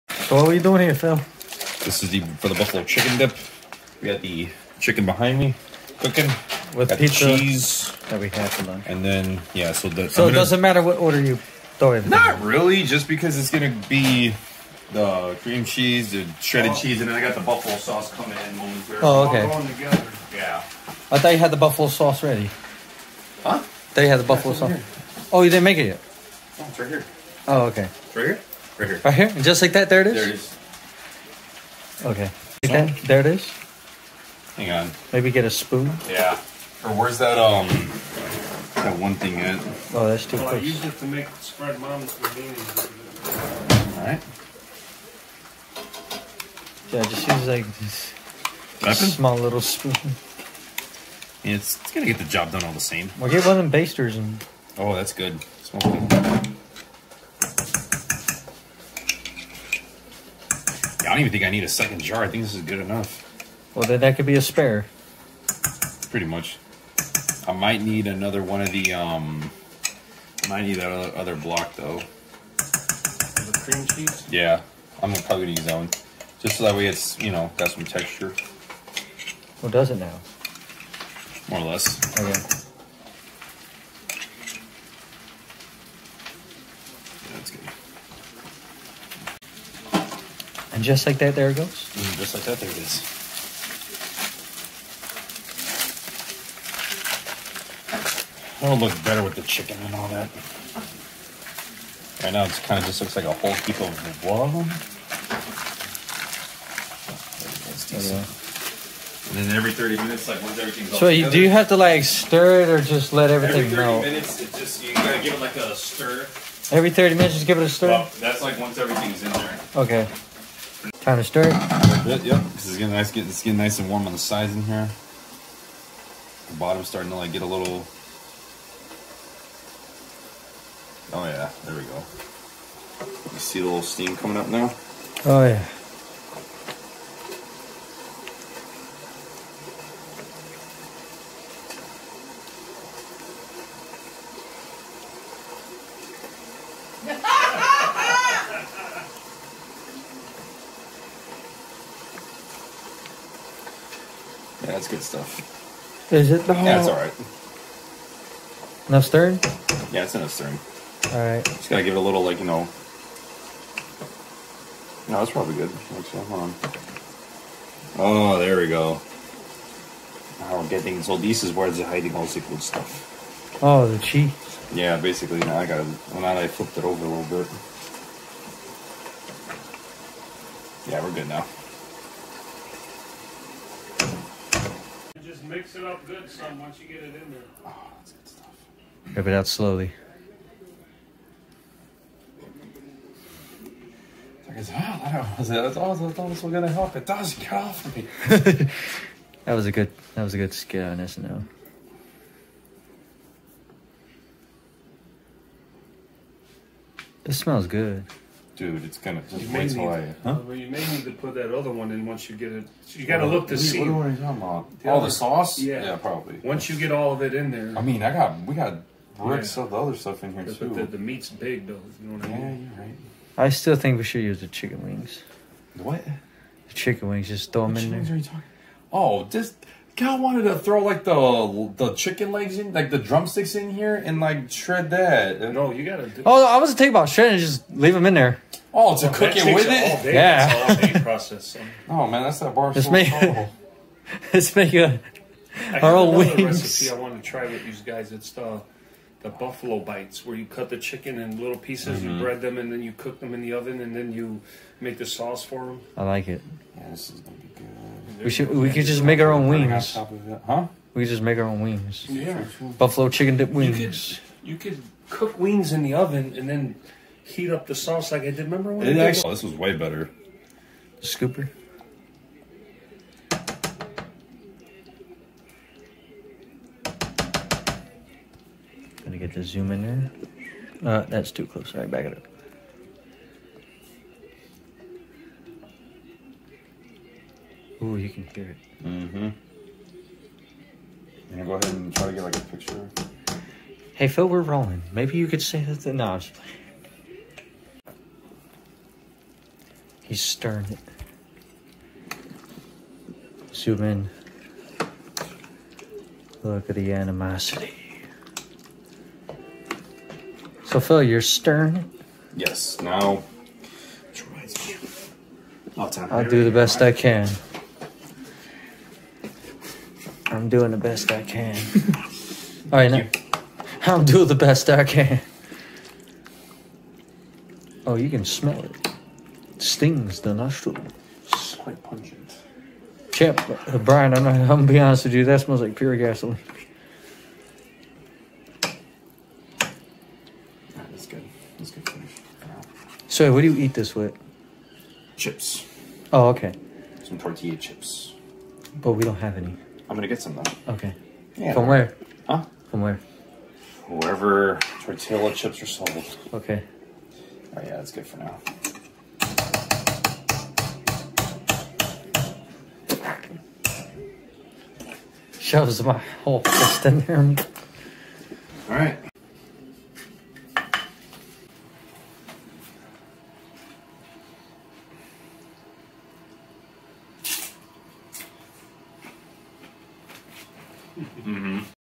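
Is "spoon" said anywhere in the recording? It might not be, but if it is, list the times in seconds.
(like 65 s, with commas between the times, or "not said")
35 s, 49 s.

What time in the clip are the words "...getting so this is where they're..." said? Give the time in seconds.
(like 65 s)
170 s.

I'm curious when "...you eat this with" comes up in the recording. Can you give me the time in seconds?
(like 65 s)
343 s.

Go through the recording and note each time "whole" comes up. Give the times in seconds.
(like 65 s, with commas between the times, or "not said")
103 s, 156 s, 366 s.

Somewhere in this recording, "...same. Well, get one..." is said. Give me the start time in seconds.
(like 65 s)
52 s.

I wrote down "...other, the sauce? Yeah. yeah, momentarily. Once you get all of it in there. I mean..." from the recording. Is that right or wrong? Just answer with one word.
wrong.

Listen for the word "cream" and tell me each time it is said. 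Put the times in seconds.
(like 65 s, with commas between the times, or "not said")
15 s, 73 s.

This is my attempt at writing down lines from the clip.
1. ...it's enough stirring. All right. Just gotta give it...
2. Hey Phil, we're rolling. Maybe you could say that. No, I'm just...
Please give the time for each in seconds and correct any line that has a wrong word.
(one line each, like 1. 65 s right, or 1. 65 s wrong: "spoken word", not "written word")
1. 160 s right
2. 293 s right.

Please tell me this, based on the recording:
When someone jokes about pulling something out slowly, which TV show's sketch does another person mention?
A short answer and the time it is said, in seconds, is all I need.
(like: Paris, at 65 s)
SNL, at 200 s.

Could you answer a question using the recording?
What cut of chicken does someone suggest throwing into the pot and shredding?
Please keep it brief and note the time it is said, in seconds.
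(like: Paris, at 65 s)
drumsticks, at 232 s.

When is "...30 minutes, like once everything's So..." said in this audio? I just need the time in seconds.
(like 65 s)
109 s.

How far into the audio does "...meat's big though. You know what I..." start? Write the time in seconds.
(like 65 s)
220 s.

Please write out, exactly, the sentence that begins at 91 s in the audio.
And mm, just like that, there it is.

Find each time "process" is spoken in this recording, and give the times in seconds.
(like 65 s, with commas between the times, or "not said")
241 s.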